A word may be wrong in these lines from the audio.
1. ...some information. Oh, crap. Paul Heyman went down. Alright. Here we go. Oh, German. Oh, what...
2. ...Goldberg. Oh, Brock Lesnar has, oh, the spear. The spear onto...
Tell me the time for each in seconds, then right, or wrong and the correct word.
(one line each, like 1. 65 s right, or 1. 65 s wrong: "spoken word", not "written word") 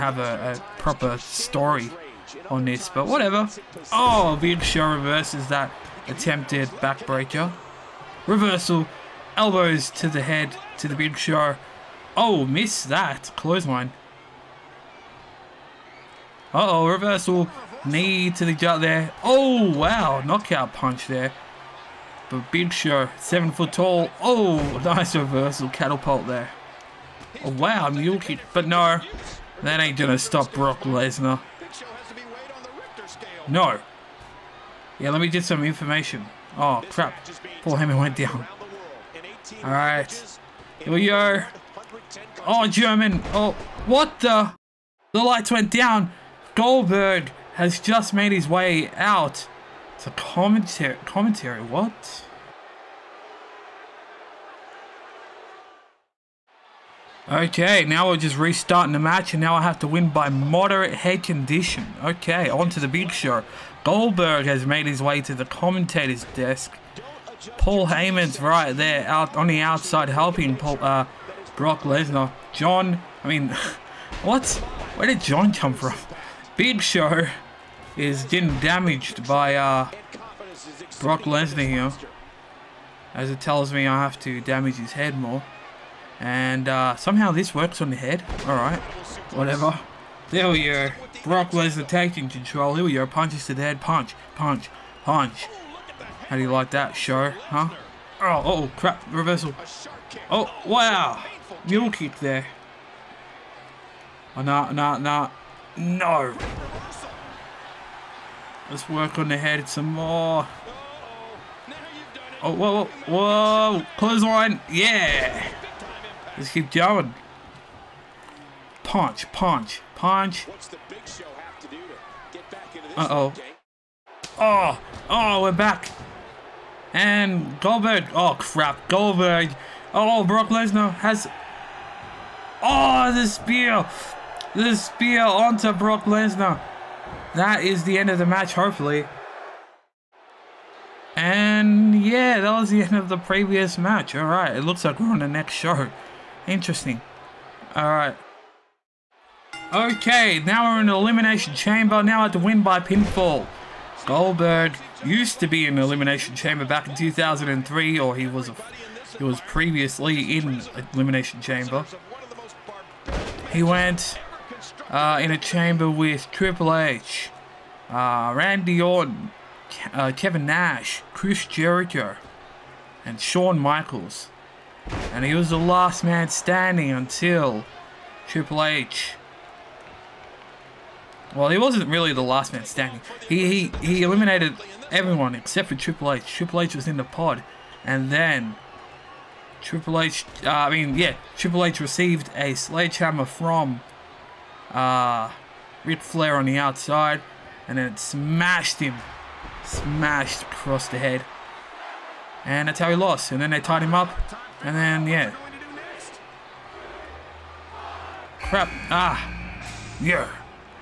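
1. 35 s right
2. 128 s right.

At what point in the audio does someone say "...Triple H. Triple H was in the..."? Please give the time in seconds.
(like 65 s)
185 s.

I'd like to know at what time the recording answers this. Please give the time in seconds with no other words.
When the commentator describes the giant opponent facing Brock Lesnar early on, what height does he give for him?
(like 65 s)
23 s.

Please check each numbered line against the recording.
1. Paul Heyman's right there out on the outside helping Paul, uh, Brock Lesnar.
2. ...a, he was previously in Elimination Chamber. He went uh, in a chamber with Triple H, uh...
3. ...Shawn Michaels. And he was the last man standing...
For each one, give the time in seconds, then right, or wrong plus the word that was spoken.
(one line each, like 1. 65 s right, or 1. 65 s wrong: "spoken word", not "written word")
1. 67 s right
2. 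158 s right
3. 173 s right.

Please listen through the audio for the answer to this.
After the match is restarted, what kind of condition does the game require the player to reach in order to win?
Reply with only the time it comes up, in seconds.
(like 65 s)
60 s.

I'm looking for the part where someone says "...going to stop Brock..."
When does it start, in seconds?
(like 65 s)
29 s.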